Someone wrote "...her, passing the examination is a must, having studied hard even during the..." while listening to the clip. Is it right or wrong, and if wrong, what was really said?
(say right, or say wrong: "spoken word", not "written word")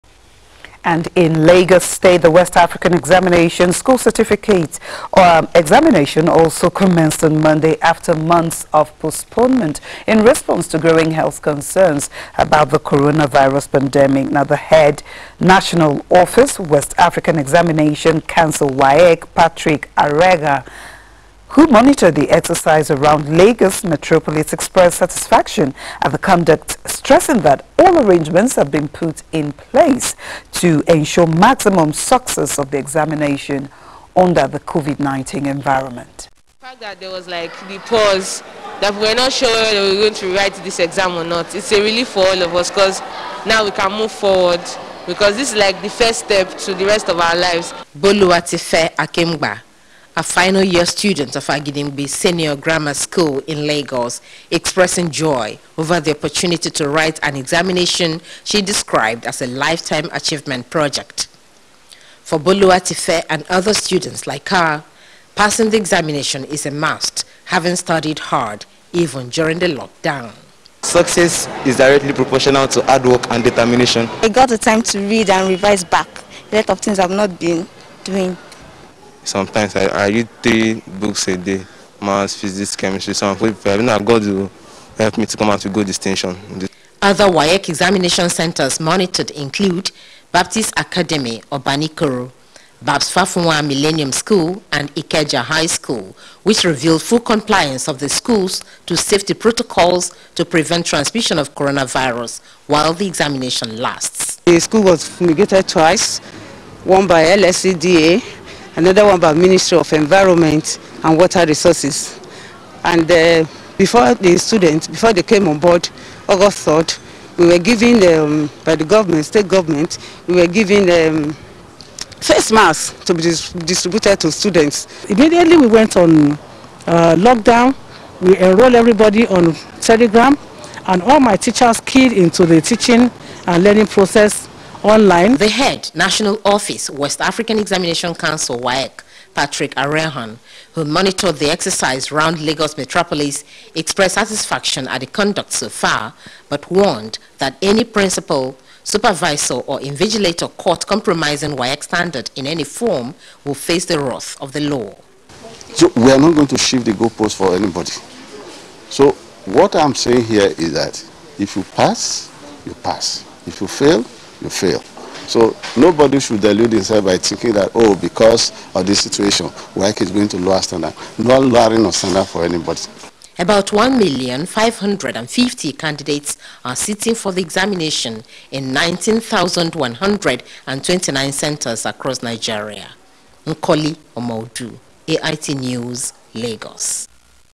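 right.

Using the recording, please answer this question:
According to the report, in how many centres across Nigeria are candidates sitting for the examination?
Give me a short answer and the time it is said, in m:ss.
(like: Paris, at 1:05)
19,129, at 2:58.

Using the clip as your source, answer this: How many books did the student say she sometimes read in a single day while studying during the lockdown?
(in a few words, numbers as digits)
3.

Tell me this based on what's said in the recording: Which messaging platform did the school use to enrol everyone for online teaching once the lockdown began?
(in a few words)
Telegram.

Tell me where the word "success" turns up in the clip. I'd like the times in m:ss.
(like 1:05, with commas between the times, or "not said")
0:31, 1:10.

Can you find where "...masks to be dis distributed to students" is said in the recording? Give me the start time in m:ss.
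2:02.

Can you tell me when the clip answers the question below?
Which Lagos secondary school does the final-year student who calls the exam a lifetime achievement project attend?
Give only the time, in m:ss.
0:51.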